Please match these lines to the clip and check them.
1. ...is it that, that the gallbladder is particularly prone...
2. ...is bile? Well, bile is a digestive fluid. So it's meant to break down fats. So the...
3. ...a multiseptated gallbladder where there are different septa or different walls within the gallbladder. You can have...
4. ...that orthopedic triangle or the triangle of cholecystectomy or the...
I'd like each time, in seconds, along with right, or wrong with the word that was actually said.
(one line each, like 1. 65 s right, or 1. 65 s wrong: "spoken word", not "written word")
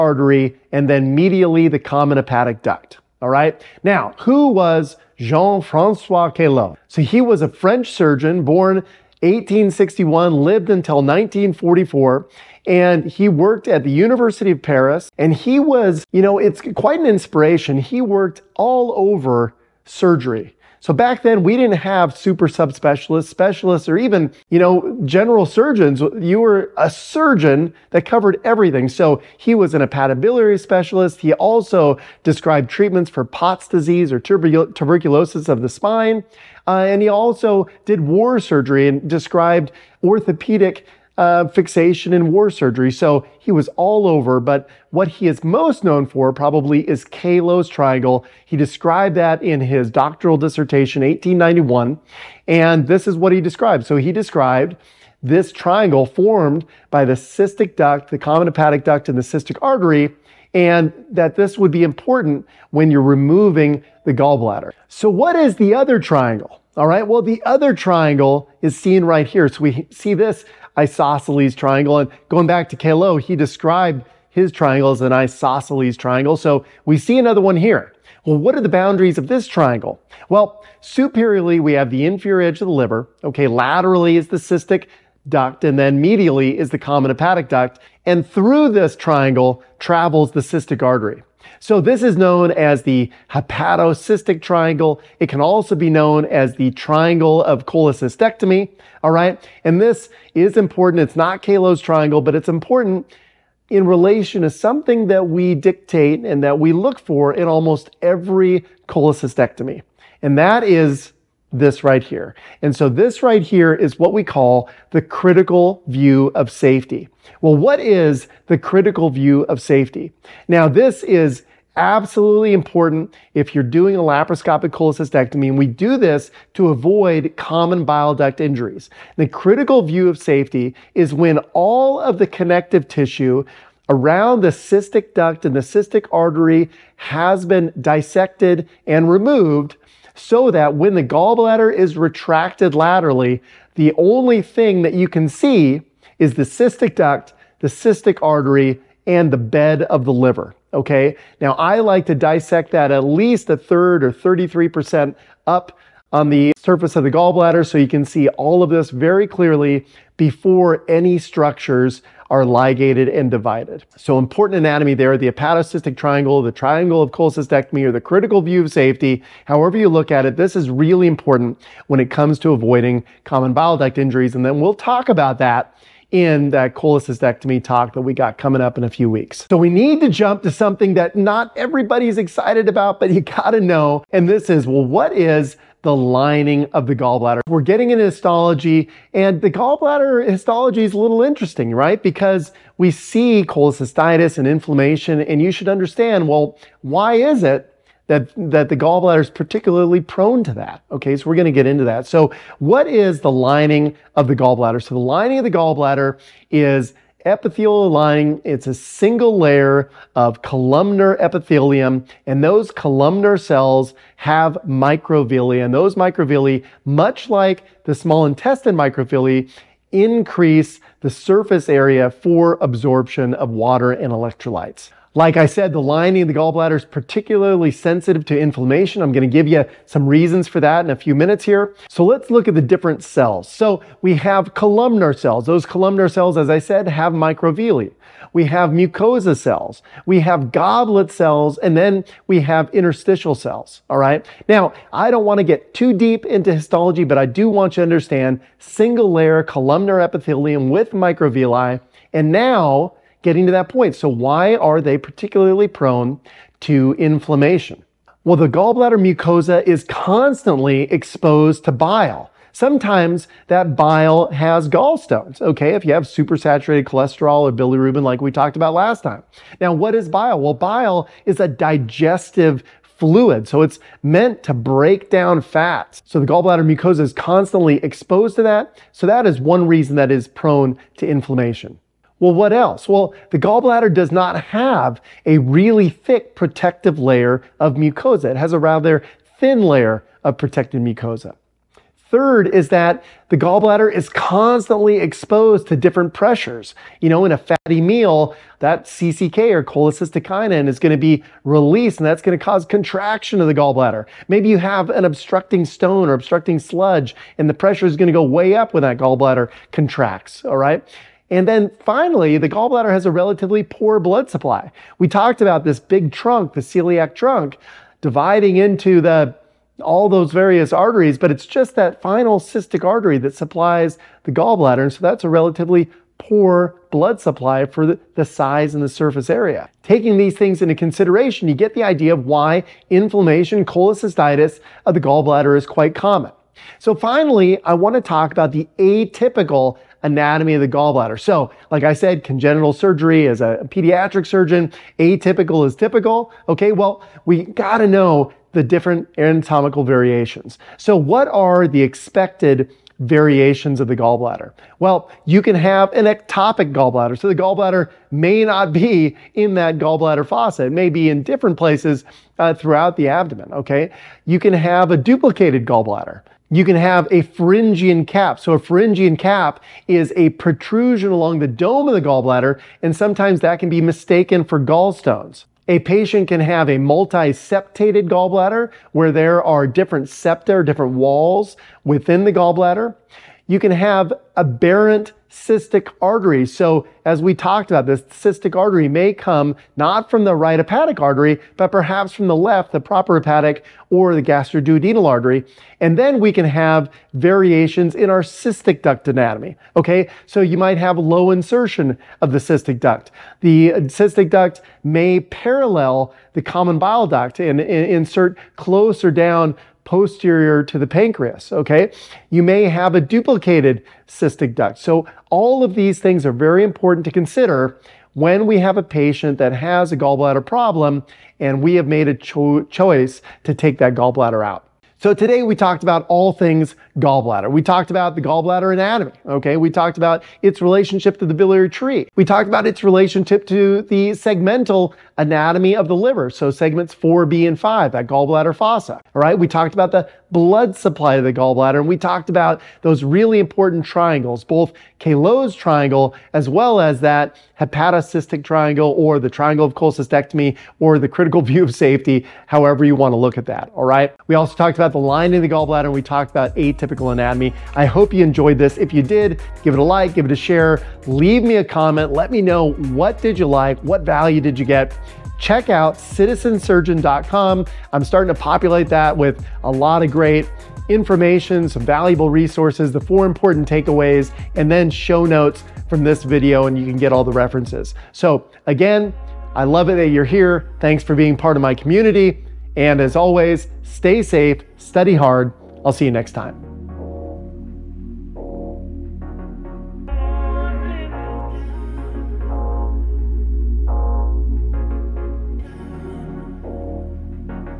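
1. 197 s right
2. 269 s right
3. 376 s right
4. 447 s wrong: "hepatocystic", not "orthopedic".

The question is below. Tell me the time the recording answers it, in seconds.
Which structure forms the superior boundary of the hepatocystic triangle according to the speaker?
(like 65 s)
82 s.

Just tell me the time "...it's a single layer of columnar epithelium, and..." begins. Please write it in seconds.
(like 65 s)
208 s.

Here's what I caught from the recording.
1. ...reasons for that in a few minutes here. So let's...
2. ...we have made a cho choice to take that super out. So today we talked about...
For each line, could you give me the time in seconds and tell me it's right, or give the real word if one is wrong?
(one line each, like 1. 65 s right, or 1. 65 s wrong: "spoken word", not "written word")
1. 230 s right
2. 421 s wrong: "gallbladder", not "super".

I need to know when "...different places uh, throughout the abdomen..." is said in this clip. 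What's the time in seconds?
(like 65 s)
361 s.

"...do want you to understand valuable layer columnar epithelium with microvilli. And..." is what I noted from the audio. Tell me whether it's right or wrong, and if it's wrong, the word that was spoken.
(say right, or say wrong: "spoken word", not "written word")
wrong: "single", not "valuable".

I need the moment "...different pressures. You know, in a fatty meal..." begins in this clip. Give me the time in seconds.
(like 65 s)
295 s.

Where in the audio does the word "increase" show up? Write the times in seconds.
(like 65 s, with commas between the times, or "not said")
219 s.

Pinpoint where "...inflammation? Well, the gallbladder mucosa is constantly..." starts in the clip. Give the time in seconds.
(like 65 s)
256 s.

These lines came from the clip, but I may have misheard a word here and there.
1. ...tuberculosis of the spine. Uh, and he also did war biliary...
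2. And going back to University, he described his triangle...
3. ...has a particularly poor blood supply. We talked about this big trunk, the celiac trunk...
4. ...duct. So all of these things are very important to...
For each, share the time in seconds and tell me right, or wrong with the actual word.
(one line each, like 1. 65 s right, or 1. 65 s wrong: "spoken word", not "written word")
1. 34 s wrong: "surgery", not "biliary"
2. 71 s wrong: "Calot", not "University"
3. 312 s wrong: "relatively", not "particularly"
4. 414 s right.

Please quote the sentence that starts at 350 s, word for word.
So, what are the expected variations of the gallbladder.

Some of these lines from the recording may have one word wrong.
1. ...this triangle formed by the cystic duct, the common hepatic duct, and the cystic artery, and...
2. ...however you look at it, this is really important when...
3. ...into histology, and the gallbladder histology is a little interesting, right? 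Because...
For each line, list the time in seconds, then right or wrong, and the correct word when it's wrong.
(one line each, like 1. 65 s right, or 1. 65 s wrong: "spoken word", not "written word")
1. 55 s right
2. 169 s right
3. 187 s right.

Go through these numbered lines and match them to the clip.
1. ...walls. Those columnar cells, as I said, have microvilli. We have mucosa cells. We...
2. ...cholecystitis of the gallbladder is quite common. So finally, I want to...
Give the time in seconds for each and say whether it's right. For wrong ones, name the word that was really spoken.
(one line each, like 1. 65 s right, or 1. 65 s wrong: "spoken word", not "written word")
1. 235 s wrong: "cells", not "walls"
2. 333 s right.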